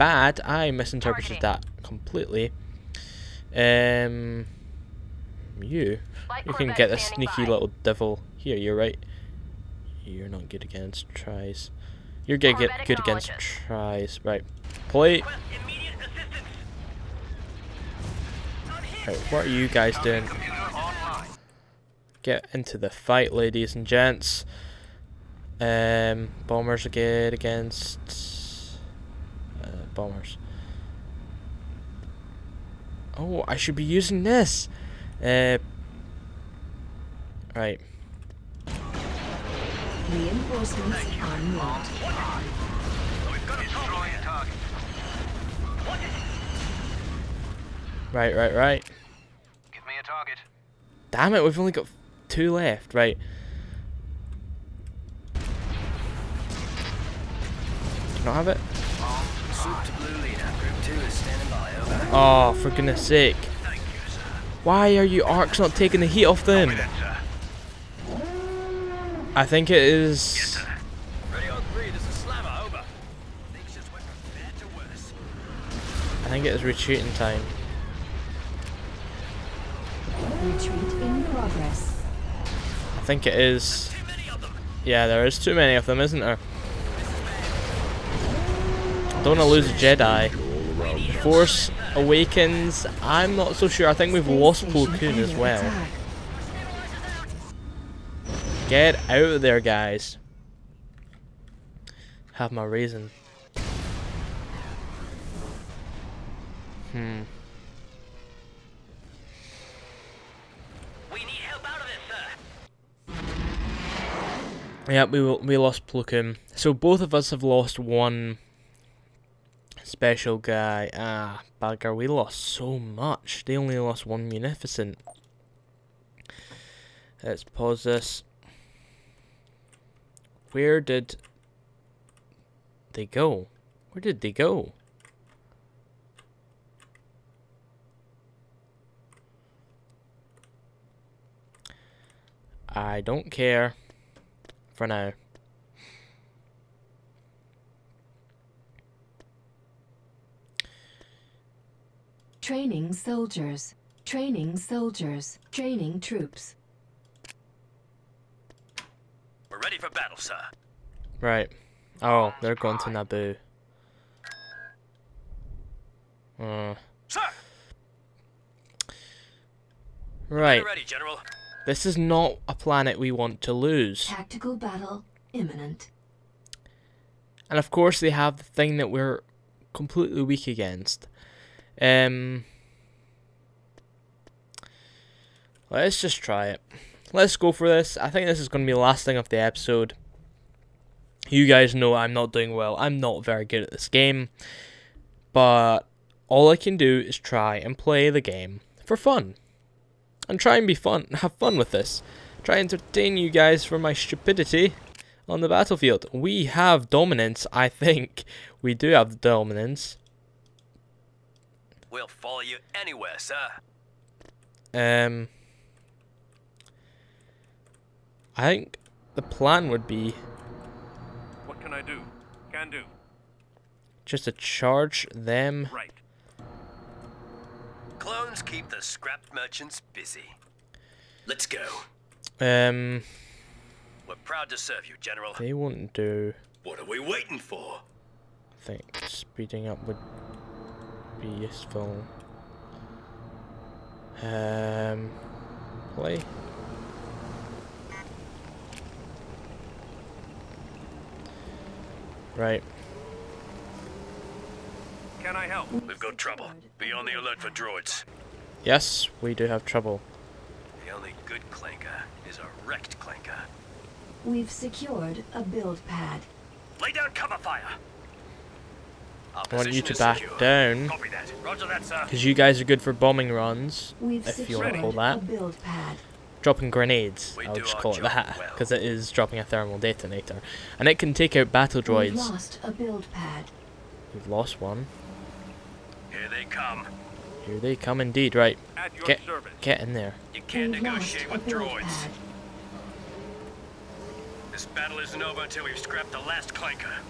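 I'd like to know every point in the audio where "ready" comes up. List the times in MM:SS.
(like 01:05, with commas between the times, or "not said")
02:39, 02:50.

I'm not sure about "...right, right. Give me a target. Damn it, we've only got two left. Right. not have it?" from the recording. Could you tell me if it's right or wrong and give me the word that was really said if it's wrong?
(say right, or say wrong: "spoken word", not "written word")
right.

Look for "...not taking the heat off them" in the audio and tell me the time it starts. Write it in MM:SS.
01:05.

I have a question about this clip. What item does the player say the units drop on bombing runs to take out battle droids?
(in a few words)
Thermal detonator.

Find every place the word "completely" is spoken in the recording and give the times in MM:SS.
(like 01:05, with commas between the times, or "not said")
00:01, 02:59.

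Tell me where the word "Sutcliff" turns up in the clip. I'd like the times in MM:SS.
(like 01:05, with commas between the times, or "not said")
not said.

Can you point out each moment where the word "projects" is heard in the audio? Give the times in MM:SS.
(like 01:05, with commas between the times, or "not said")
not said.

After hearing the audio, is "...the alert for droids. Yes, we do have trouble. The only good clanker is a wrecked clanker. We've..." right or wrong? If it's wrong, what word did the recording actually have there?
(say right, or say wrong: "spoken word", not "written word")
right.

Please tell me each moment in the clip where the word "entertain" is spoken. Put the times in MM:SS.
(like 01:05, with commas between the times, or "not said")
03:22.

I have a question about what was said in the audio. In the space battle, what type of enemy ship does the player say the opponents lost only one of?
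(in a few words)
Munificent.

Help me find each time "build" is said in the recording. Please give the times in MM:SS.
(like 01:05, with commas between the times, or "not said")
04:25, 04:42.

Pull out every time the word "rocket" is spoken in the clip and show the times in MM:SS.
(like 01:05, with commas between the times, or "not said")
not said.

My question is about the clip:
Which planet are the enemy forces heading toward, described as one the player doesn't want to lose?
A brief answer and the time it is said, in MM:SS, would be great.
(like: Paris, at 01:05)
Naboo, at 02:42.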